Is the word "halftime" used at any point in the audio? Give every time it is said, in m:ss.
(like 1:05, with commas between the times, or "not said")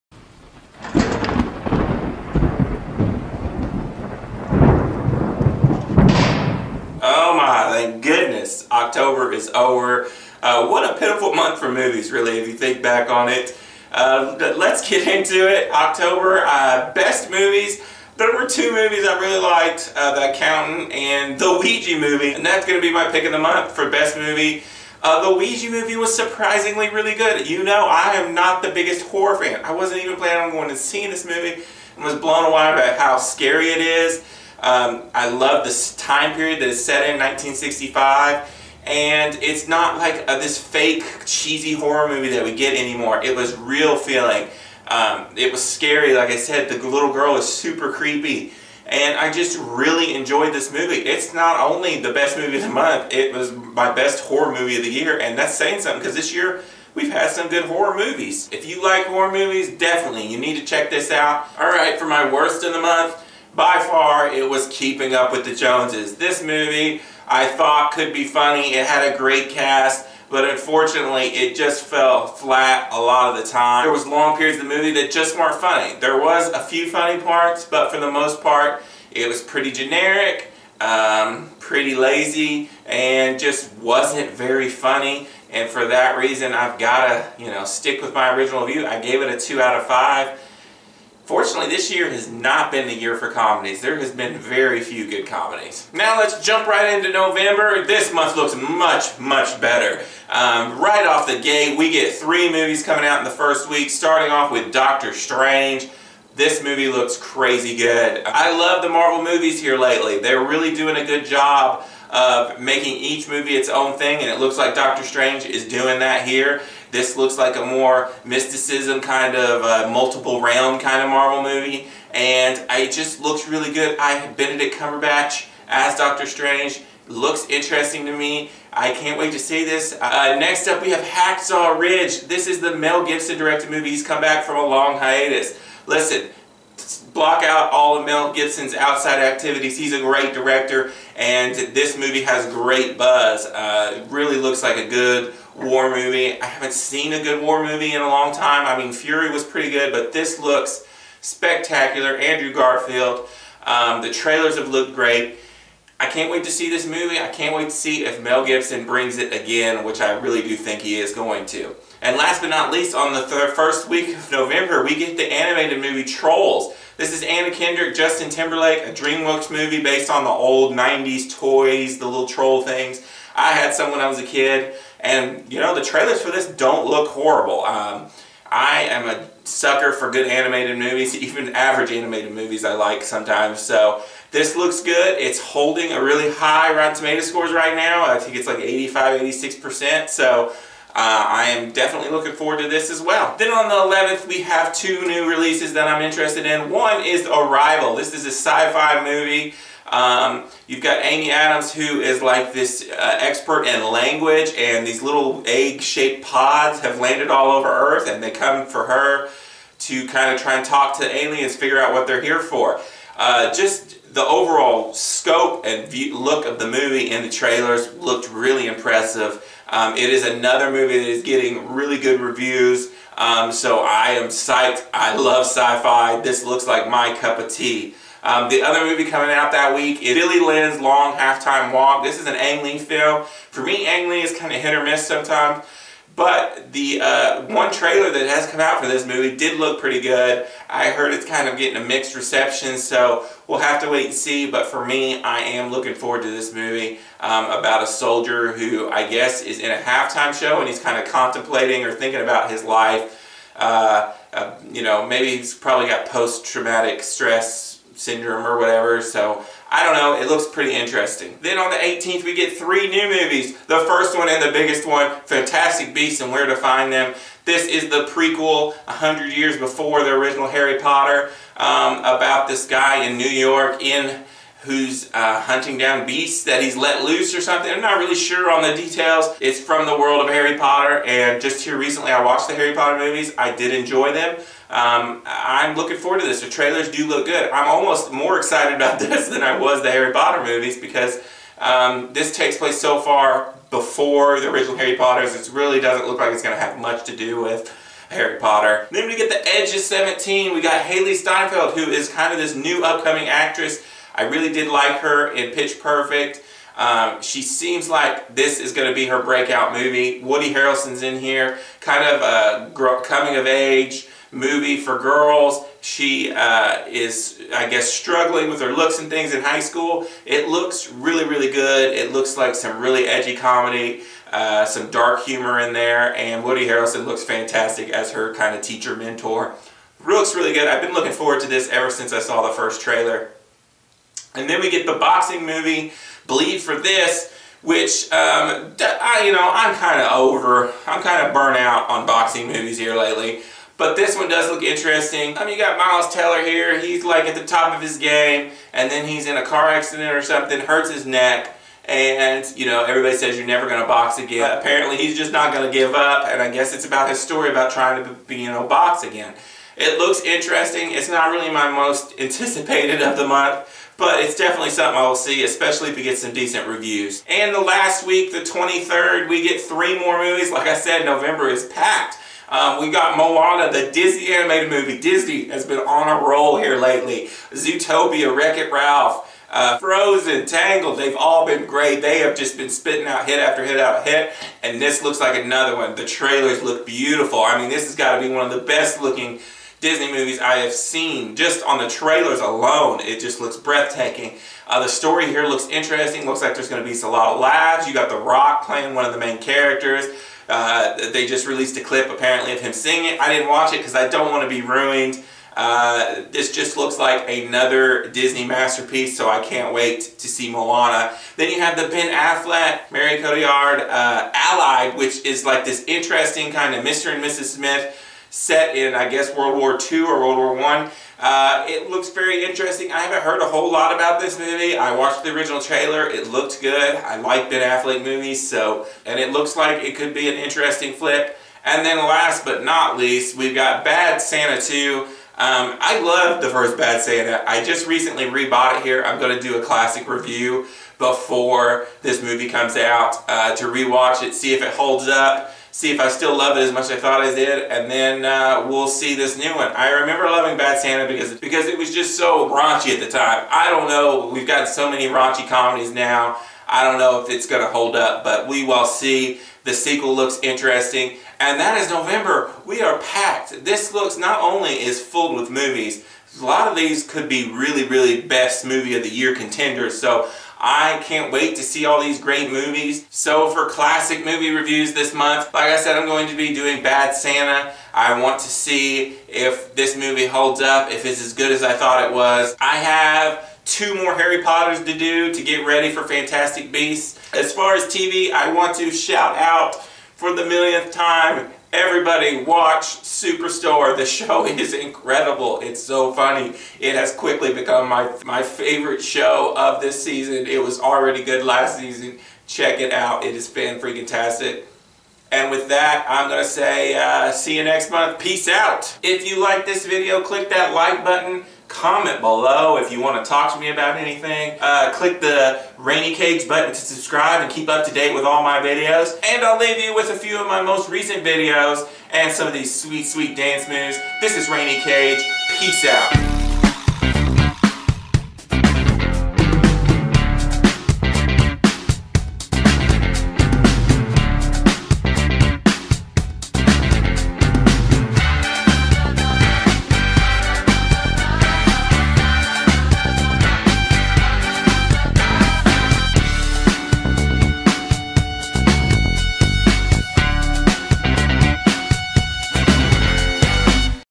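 3:51, 4:09.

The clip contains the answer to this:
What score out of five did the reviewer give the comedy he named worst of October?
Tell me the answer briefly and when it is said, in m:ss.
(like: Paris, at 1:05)
2 out of 5, at 1:29.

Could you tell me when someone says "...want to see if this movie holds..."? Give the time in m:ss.
7:58.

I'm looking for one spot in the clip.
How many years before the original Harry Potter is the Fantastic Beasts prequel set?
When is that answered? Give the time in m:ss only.
4:28.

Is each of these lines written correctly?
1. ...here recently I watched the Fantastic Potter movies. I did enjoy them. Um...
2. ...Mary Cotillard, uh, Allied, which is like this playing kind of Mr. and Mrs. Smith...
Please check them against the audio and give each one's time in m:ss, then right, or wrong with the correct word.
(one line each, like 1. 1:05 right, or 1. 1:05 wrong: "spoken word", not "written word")
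1. 4:41 wrong: "Harry", not "Fantastic"
2. 6:52 wrong: "interesting", not "playing".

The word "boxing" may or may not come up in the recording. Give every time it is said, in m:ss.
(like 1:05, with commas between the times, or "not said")
5:34, 5:42.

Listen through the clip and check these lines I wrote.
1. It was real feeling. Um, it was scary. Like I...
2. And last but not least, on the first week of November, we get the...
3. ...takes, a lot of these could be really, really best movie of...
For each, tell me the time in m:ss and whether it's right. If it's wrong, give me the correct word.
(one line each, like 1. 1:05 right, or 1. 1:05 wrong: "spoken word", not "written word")
1. 0:43 right
2. 2:42 right
3. 7:45 wrong: "movies", not "takes".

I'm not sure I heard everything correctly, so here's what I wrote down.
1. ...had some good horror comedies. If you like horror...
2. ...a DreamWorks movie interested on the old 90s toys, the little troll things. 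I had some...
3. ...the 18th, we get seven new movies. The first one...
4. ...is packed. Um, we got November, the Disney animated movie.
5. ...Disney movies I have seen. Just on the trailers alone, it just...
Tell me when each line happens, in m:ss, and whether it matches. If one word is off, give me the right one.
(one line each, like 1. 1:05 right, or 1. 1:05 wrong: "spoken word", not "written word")
1. 0:57 wrong: "movies", not "comedies"
2. 2:48 wrong: "based", not "interested"
3. 4:21 wrong: "three", not "seven"
4. 6:11 wrong: "Moana", not "November"
5. 6:29 right.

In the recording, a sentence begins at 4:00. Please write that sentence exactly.
I heard it's kind of getting a mixed reception, so we'll have to wait and see.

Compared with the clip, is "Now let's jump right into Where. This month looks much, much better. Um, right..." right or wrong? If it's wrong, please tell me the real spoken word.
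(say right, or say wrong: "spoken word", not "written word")
wrong: "November", not "Where".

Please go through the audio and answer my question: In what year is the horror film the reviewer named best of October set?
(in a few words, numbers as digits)
1965.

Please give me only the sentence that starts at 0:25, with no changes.
Uh, the Ouija movie was surprisingly really good.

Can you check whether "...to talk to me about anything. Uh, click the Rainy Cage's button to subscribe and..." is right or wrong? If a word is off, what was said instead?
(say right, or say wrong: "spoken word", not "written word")
right.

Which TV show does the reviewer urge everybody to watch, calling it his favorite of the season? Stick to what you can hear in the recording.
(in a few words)
Superstore.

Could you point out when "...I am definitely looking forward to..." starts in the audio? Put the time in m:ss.
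3:10.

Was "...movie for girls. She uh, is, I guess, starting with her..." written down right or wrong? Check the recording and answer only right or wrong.
wrong.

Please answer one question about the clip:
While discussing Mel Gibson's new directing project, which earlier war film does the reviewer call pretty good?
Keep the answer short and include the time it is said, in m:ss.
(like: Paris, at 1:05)
Fury, at 2:28.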